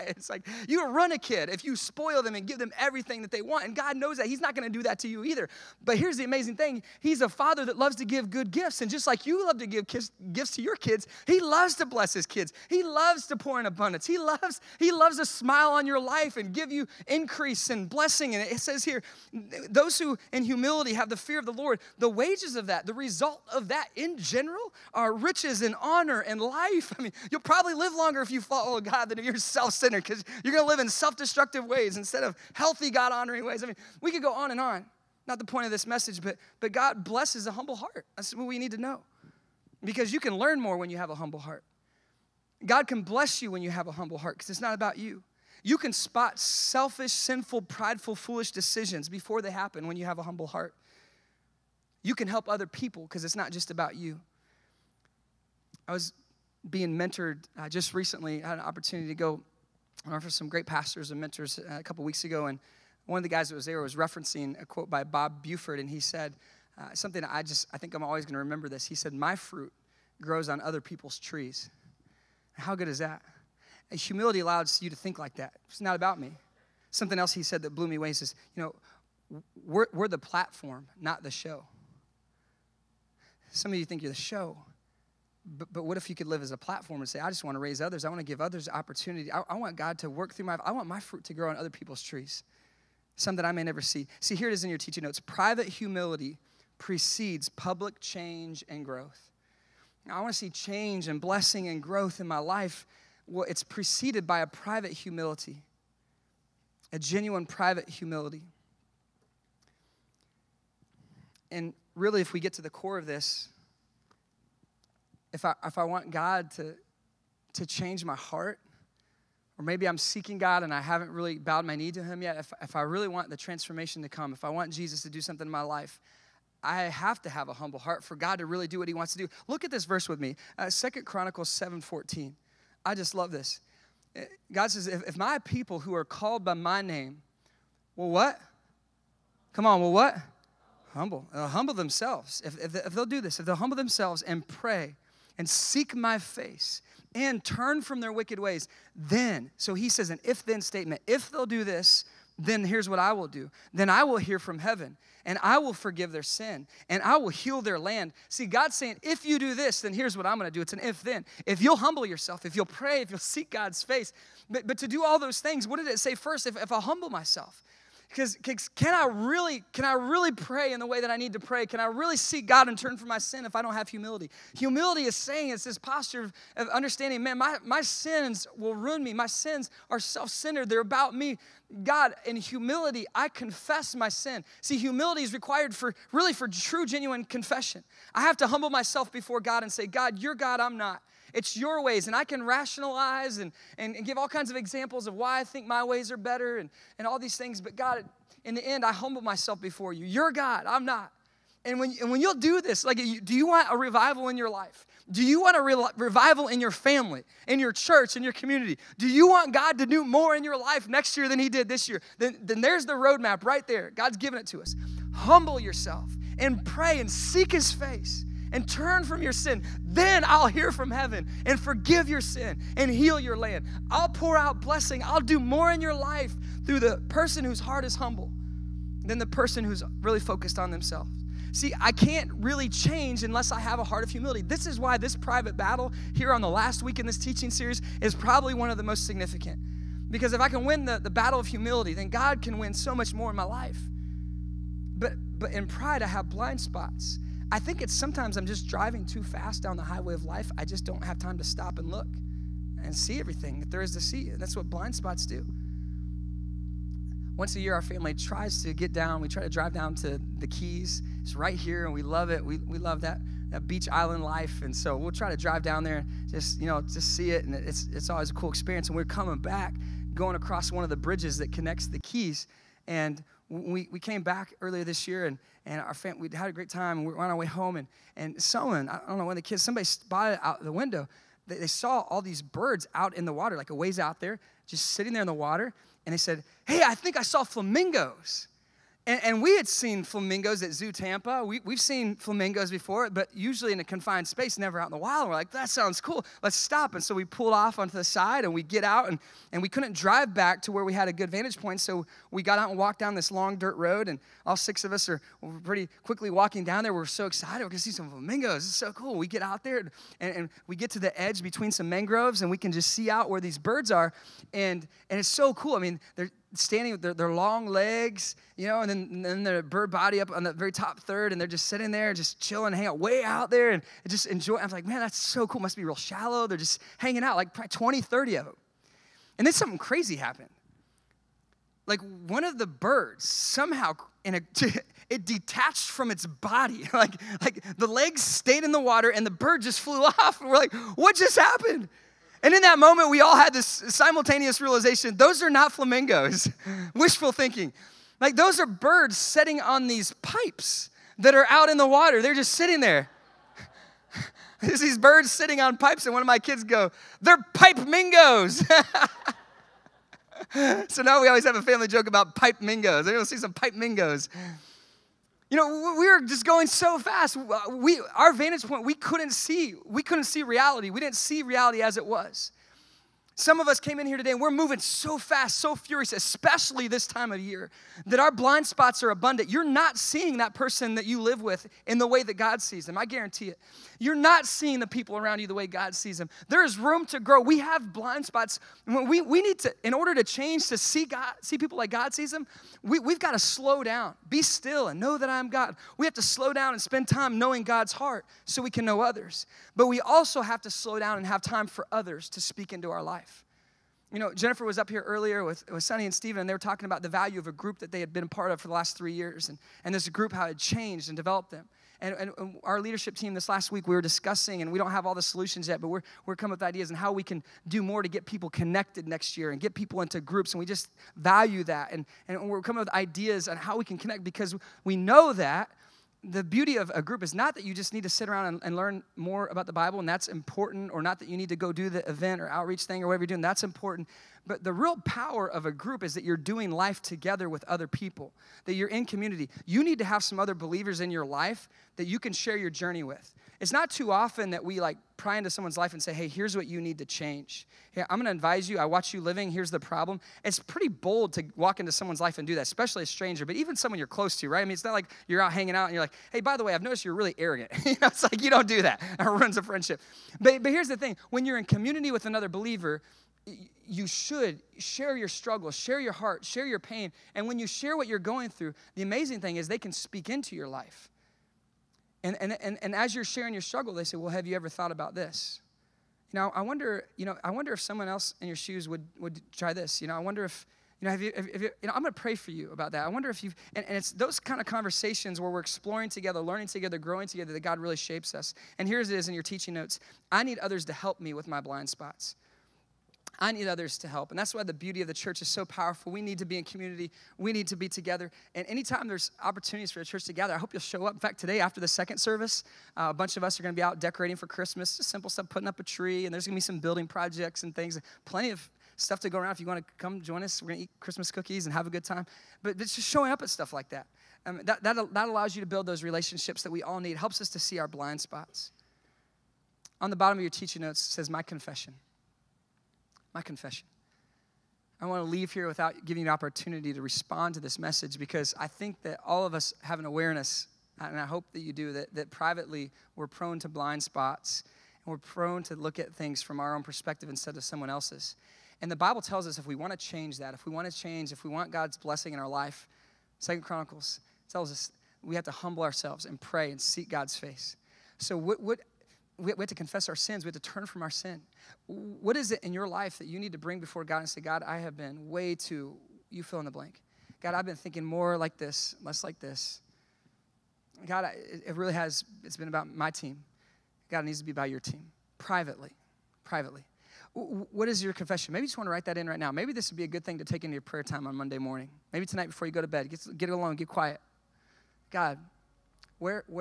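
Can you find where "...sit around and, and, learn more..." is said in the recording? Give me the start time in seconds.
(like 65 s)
428 s.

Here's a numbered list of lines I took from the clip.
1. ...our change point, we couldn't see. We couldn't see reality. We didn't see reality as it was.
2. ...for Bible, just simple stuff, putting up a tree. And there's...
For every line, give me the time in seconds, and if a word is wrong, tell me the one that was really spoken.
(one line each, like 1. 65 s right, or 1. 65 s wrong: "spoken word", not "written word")
1. 368 s wrong: "vantage", not "change"
2. 504 s wrong: "Christmas", not "Bible".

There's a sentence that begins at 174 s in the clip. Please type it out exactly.
Humility is saying it's this posture of, understanding, man, my, my sins will ruin me.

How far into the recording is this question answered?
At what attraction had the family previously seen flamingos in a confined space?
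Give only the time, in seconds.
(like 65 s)
290 s.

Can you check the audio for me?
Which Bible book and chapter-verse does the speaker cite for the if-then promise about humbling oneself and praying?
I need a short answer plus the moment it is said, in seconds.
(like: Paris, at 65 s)
Second Chronicles 7:14, at 130 s.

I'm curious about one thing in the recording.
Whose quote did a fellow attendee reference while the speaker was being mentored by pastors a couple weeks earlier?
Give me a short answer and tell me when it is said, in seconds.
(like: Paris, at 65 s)
Bob Buford, at 65 s.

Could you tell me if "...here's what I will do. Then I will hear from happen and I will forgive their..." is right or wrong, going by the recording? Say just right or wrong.
wrong.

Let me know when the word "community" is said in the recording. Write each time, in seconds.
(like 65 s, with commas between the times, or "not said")
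208 s, 439 s, 461 s, 496 s.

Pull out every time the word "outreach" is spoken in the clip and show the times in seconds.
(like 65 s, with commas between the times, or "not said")
432 s.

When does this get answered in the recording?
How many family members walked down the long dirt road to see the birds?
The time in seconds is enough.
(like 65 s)
304 s.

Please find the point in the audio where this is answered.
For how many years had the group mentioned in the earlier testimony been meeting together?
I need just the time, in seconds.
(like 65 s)
408 s.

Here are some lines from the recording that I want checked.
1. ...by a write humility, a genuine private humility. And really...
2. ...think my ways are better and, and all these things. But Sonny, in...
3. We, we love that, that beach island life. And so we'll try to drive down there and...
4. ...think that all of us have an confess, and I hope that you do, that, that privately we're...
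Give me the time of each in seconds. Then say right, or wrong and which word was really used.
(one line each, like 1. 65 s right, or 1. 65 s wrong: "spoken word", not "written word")
1. 104 s wrong: "private", not "write"
2. 195 s wrong: "God", not "Sonny"
3. 262 s right
4. 528 s wrong: "awareness", not "confess".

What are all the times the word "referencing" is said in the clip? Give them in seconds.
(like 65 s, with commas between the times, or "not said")
63 s.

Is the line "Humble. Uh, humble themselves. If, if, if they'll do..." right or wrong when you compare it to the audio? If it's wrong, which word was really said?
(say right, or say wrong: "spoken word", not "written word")
right.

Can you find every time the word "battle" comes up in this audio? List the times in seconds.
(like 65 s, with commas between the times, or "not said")
235 s, 241 s.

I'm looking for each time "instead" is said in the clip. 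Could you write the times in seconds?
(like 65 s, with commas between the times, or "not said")
31 s, 537 s.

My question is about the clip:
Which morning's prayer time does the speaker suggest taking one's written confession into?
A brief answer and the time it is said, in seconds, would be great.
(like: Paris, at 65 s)
Monday, at 571 s.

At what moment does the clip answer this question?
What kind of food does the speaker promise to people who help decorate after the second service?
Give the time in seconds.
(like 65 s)
510 s.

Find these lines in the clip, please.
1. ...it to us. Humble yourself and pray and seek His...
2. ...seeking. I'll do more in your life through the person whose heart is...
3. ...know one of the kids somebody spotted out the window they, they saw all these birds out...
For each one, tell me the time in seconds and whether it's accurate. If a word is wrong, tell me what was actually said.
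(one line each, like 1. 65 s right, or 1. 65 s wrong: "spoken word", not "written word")
1. 214 s right
2. 224 s wrong: "blessing", not "seeking"
3. 279 s right.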